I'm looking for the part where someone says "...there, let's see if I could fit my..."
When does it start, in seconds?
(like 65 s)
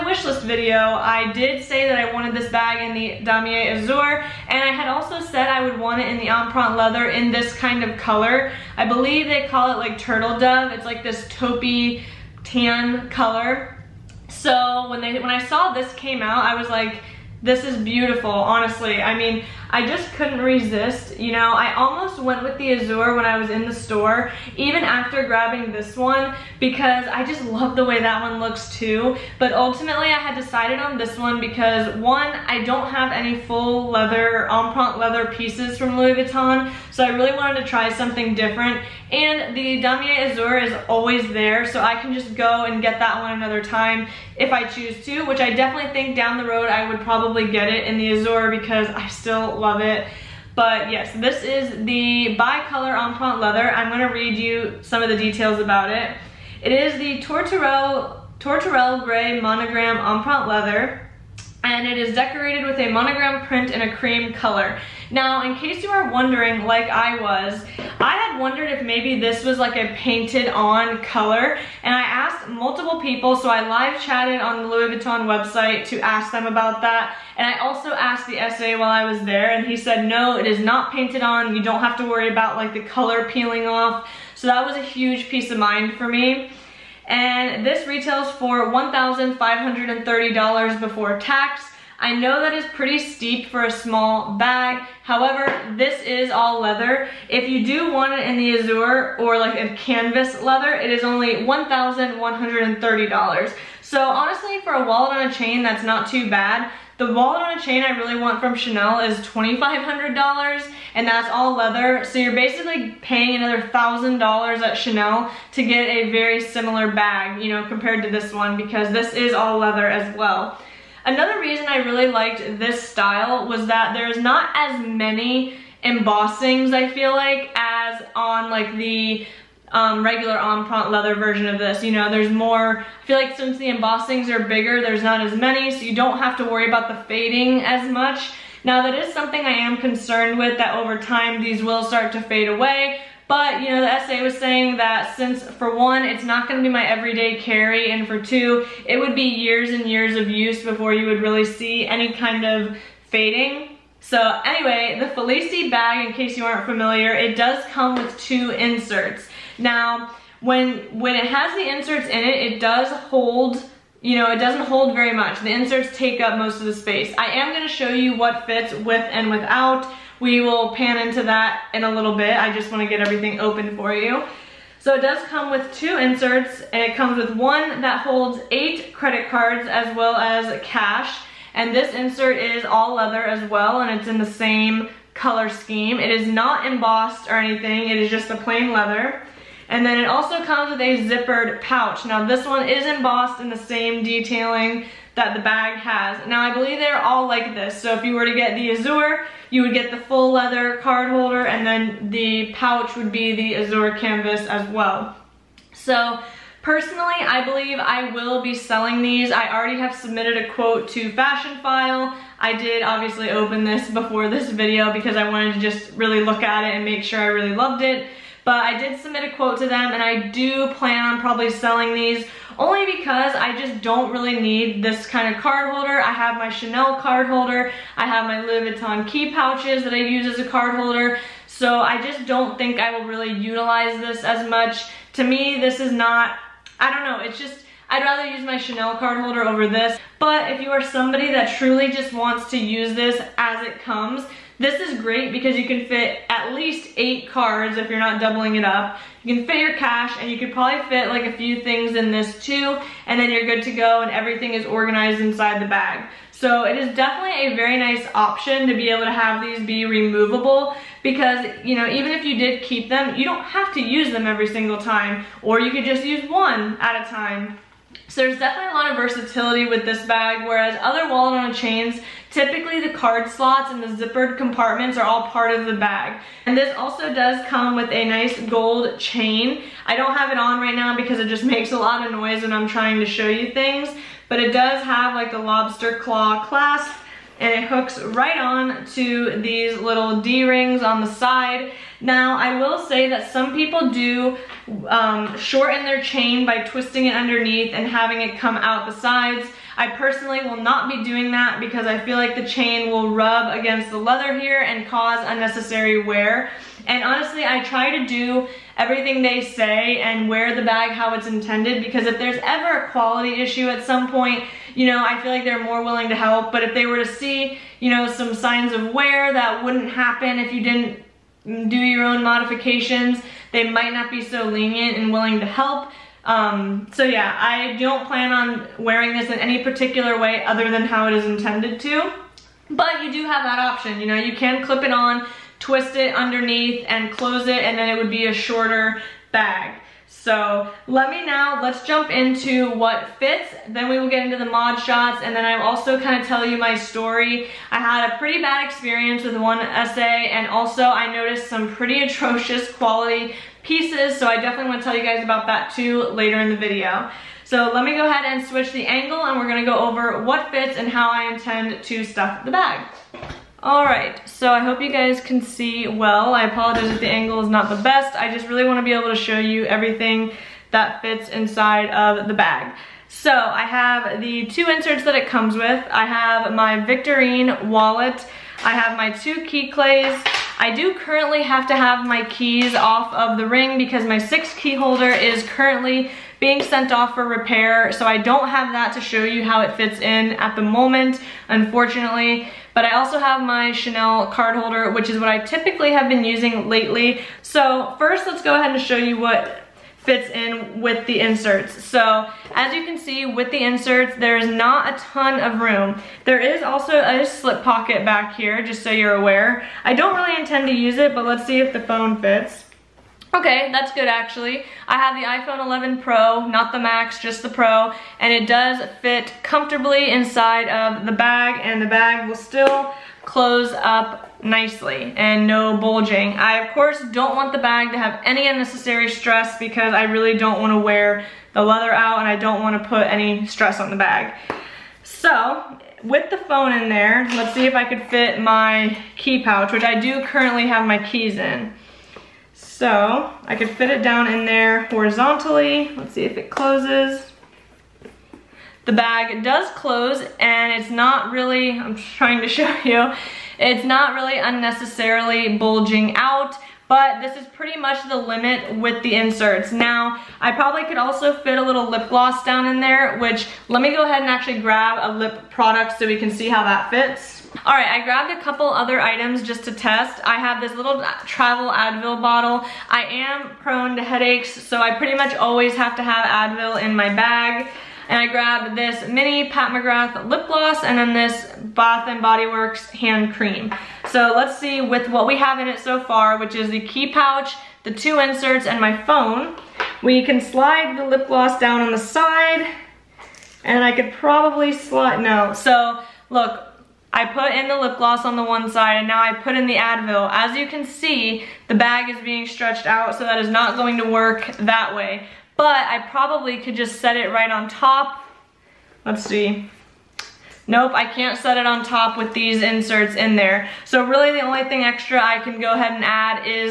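436 s.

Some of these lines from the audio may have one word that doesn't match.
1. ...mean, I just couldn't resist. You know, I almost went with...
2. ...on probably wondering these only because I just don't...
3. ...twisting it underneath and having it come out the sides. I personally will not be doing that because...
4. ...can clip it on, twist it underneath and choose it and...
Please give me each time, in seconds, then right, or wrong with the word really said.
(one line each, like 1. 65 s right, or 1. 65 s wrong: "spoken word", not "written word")
1. 19 s right
2. 221 s wrong: "selling", not "wondering"
3. 296 s right
4. 334 s wrong: "close", not "choose".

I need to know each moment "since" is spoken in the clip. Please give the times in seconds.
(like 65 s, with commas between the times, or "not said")
133 s, 145 s.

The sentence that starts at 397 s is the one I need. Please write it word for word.
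So first, let's go ahead and show you what fits in with the inserts.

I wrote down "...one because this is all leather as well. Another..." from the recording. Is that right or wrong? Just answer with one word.
right.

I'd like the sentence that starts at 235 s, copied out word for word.
To me, this is not, I don't know, it's just, I'd rather use my Chanel card holder over this.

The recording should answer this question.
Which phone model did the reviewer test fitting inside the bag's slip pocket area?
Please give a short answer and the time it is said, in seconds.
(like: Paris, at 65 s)
iPhone 11 Pro, at 415 s.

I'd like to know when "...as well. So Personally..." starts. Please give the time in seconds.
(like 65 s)
204 s.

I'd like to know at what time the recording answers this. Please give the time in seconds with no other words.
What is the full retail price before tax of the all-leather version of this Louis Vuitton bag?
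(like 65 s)
88 s.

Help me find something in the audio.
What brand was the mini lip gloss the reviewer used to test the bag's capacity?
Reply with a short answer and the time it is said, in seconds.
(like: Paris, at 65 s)
Pat McGrath, at 479 s.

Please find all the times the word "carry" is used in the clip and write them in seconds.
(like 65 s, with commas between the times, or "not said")
147 s.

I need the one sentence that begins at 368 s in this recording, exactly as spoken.
I just really wanna be able to show you everything that fits inside of the bag.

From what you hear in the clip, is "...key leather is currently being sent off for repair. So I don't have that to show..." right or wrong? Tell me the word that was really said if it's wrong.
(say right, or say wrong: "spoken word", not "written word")
wrong: "holder", not "leather".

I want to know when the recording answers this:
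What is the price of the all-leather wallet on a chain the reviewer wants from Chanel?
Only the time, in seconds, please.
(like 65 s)
109 s.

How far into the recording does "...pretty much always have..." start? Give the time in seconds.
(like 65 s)
474 s.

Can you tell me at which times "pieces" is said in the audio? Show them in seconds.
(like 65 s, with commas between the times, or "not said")
35 s, 85 s, 353 s.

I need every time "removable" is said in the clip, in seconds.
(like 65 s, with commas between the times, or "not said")
259 s.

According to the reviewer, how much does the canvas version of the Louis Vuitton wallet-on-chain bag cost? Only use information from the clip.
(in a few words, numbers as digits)
$1,130.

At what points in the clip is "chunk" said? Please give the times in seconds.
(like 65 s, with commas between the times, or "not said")
not said.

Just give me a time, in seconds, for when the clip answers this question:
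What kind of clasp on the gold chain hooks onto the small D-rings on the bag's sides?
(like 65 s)
285 s.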